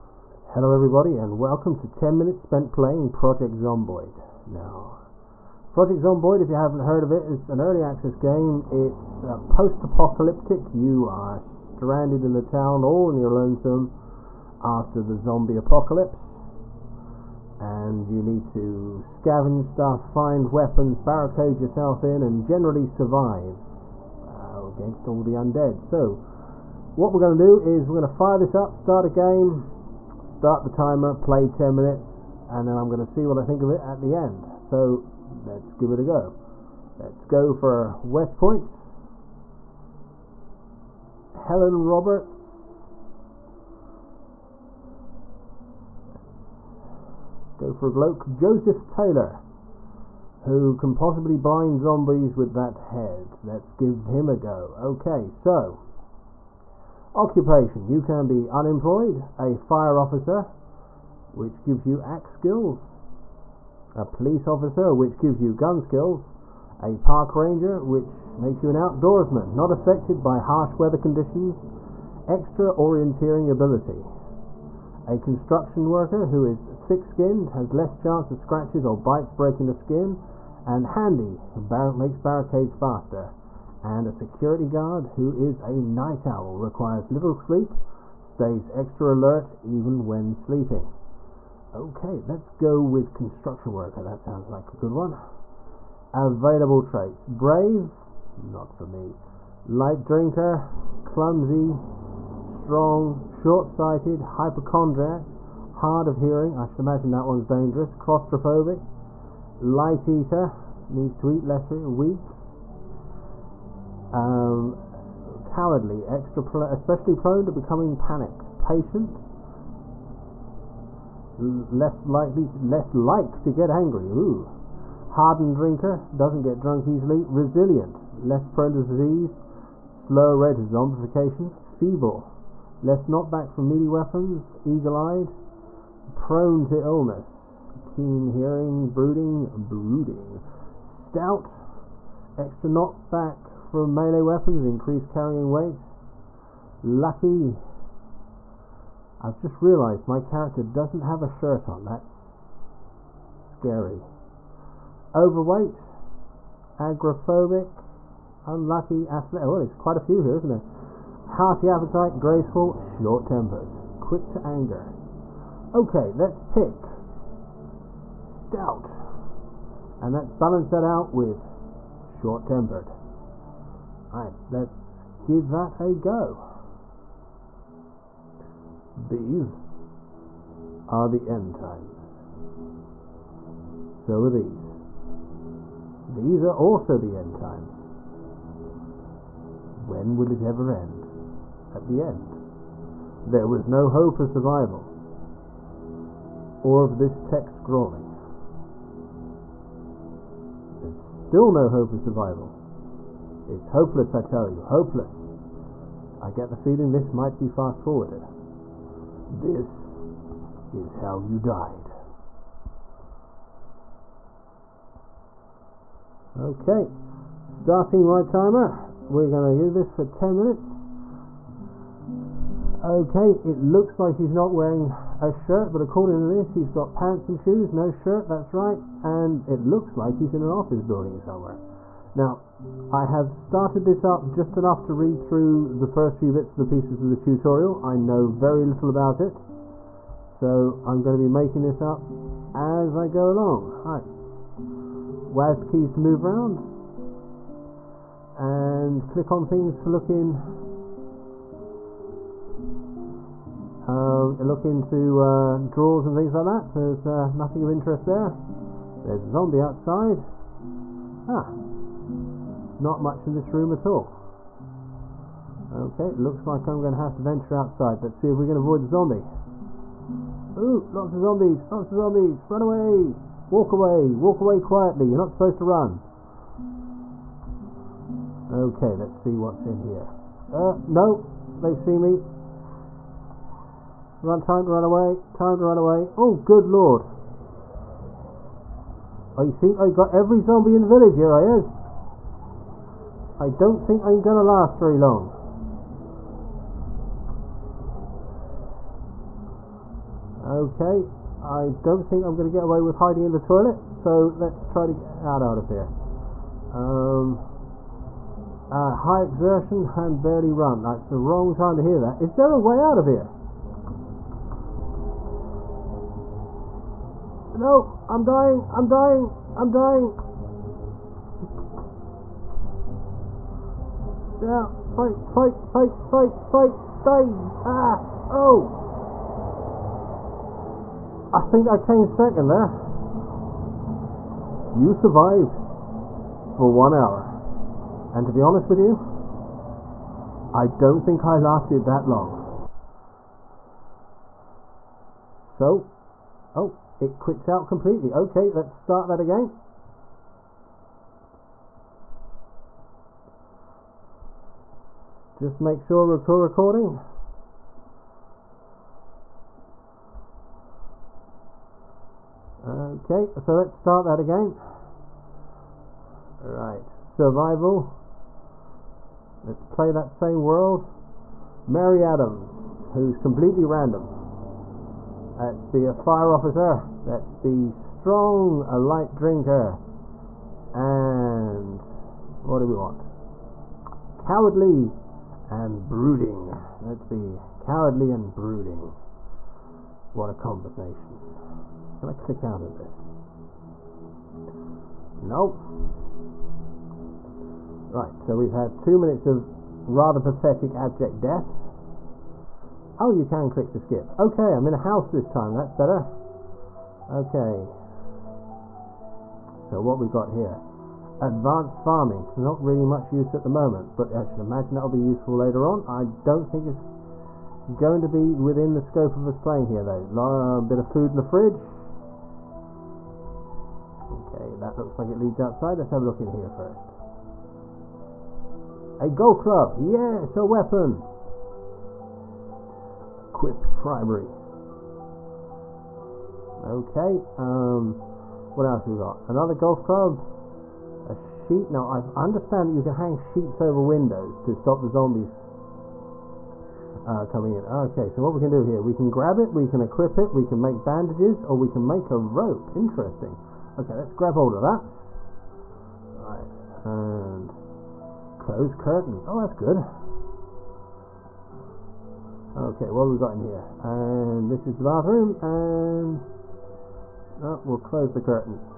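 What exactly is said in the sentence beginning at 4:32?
Run away, walk away, walk away quietly.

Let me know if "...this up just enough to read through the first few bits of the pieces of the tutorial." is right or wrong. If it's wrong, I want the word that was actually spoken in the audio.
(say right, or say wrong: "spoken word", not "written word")
right.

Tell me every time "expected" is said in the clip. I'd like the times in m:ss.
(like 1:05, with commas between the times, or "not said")
not said.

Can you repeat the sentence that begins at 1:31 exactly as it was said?
Okay, let's go with construction worker.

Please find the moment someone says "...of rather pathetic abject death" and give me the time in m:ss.
6:39.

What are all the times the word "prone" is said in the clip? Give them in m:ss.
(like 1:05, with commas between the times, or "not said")
1:57, 2:08, 2:16.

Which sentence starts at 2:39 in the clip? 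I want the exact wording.
Well, there's quite a few here, isn't there?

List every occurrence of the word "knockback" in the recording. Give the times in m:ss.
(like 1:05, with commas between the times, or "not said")
2:13, 2:22.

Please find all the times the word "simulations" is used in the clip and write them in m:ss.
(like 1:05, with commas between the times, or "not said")
not said.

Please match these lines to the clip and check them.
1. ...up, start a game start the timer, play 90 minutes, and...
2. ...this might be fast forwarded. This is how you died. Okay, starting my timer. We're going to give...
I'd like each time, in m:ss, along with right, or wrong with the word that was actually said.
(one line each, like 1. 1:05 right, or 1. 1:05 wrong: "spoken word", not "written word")
1. 0:28 wrong: "10", not "90"
2. 3:26 right.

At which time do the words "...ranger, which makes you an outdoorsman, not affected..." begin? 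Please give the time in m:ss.
1:07.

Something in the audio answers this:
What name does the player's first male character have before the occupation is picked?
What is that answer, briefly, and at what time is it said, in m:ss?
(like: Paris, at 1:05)
Joseph Taylor, at 0:48.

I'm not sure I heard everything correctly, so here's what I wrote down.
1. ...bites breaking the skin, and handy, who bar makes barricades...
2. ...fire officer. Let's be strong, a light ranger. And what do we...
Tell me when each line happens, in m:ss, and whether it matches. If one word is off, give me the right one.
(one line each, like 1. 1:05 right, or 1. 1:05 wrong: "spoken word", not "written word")
1. 1:18 right
2. 6:15 wrong: "drinker", not "ranger".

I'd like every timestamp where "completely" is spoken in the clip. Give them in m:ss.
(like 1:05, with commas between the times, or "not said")
5:47, 6:13.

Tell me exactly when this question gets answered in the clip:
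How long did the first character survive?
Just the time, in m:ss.
5:36.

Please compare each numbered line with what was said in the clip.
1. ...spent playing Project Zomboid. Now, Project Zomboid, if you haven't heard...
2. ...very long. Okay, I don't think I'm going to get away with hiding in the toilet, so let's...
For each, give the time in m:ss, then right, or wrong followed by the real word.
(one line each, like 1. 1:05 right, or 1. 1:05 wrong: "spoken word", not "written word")
1. 0:02 right
2. 4:54 right.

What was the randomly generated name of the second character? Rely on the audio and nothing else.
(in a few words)
Mary Adams.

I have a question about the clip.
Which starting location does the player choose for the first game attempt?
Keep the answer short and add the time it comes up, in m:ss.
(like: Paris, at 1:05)
West Point, at 0:38.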